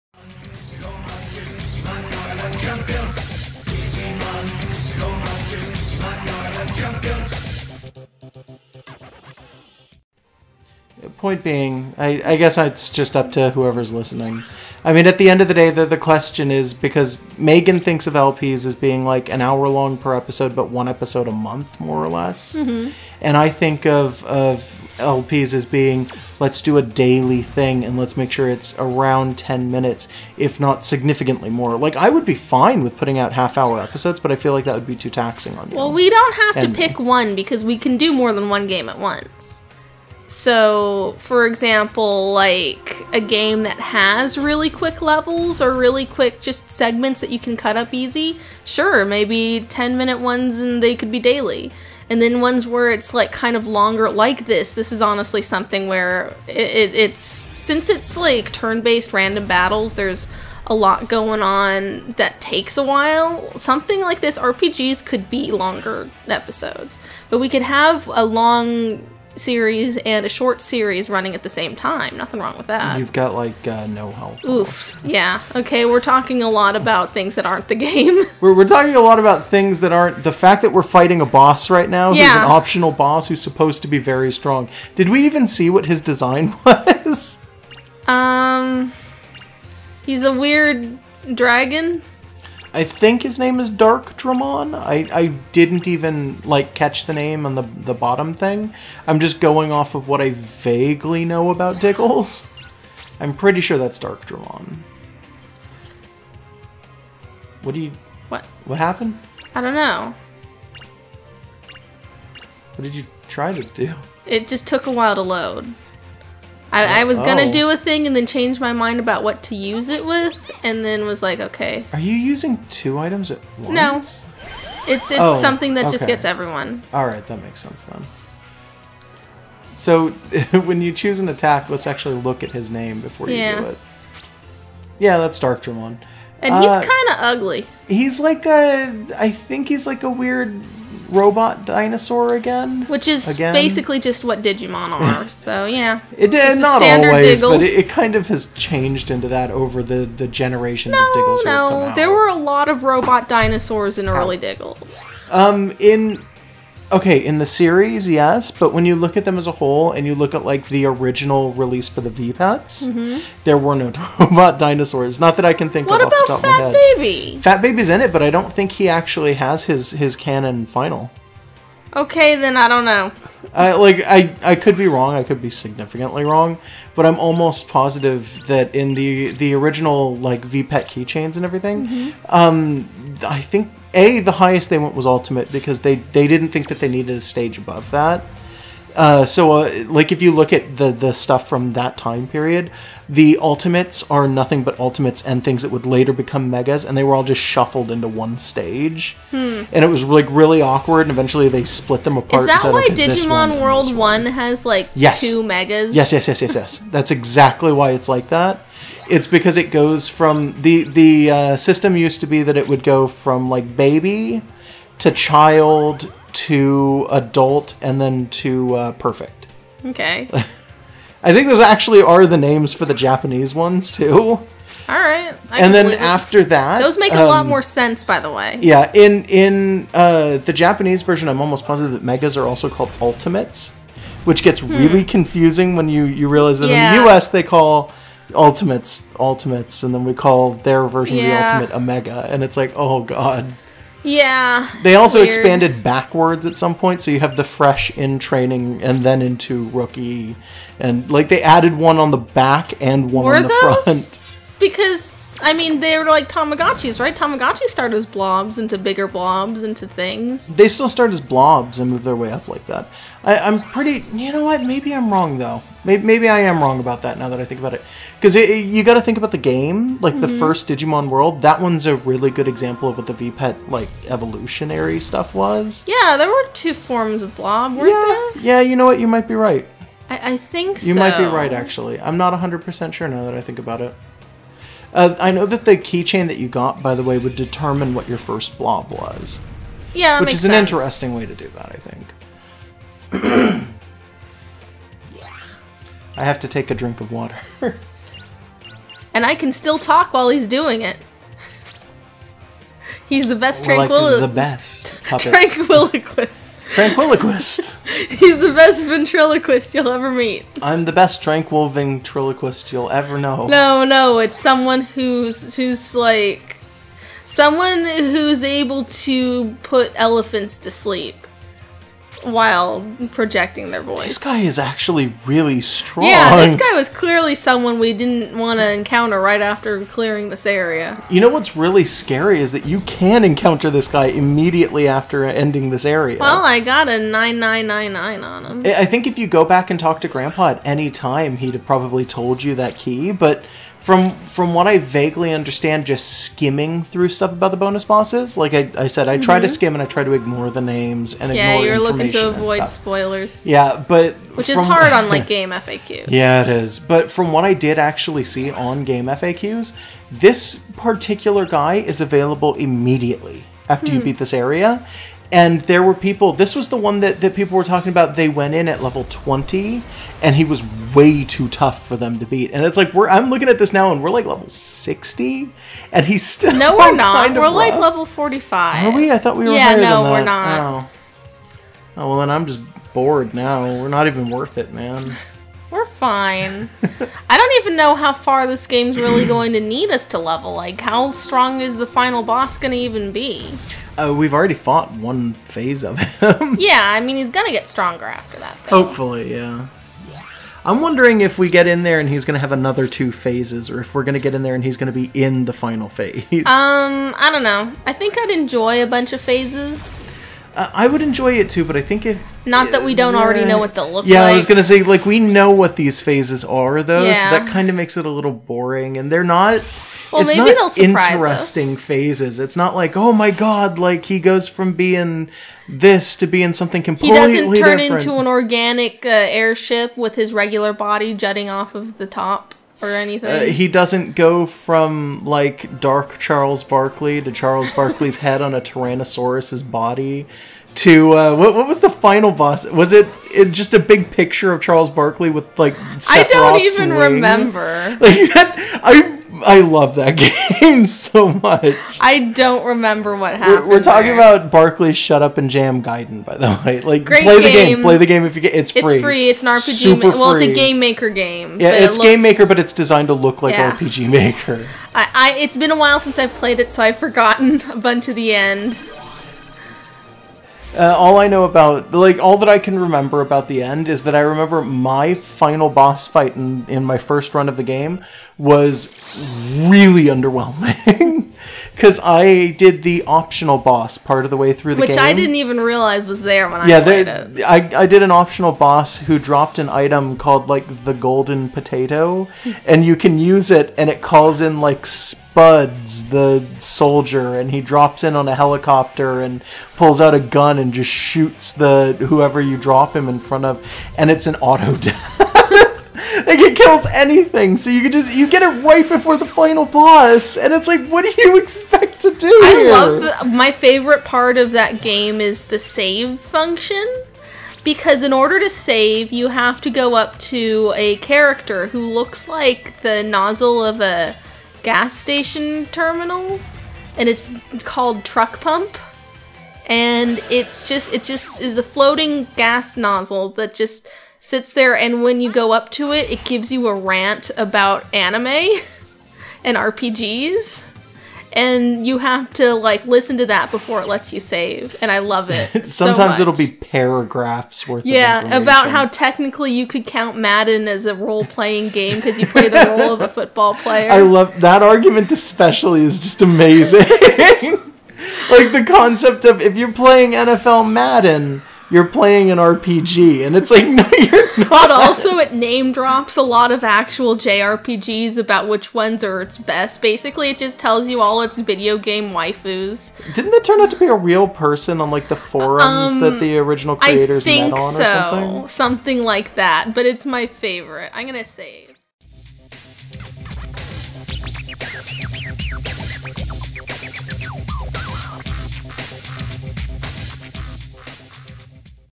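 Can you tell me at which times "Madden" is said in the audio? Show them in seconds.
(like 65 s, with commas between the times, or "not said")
550 s, 560 s.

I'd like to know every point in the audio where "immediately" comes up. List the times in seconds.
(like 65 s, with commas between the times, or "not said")
334 s, 362 s.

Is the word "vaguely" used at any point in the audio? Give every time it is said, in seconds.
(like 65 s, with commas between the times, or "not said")
100 s, 344 s.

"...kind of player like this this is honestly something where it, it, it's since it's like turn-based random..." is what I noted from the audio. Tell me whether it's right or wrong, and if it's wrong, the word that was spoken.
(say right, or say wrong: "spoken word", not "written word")
wrong: "longer", not "player".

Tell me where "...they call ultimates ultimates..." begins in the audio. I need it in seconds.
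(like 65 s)
237 s.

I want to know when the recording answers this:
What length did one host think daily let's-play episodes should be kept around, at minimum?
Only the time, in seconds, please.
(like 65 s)
29 s.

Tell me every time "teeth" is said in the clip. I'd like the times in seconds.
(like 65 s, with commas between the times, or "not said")
not said.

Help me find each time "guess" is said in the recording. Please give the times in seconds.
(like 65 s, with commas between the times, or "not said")
12 s.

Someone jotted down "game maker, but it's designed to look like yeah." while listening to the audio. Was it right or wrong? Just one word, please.
right.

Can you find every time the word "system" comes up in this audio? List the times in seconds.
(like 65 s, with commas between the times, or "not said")
211 s.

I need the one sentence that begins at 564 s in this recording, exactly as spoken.
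But also, it name drops a lot of actual JRPGs about which ones are its best.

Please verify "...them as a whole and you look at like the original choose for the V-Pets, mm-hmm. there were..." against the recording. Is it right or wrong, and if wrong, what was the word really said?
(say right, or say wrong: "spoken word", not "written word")
wrong: "release", not "choose".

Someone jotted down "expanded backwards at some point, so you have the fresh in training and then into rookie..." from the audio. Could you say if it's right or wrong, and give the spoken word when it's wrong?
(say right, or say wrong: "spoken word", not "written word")
right.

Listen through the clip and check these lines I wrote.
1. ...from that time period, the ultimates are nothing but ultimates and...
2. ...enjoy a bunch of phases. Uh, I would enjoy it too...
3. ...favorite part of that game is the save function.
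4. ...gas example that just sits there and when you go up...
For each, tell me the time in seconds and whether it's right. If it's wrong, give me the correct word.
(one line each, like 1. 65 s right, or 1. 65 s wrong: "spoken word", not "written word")
1. 191 s right
2. 408 s right
3. 513 s right
4. 532 s wrong: "nozzle", not "example".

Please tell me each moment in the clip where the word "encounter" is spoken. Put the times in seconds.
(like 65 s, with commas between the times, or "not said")
328 s, 333 s.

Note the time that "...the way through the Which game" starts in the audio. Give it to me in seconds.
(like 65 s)
484 s.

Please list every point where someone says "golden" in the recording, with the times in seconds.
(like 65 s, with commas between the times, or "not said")
490 s.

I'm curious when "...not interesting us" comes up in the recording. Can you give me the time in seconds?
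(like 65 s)
420 s.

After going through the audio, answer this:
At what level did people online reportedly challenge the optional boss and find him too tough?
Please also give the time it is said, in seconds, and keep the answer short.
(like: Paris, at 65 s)
20, at 368 s.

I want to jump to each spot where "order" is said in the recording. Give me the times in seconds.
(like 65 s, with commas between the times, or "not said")
518 s.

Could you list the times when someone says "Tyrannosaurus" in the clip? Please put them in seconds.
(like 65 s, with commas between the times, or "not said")
438 s.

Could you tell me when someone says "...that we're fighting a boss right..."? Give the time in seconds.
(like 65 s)
80 s.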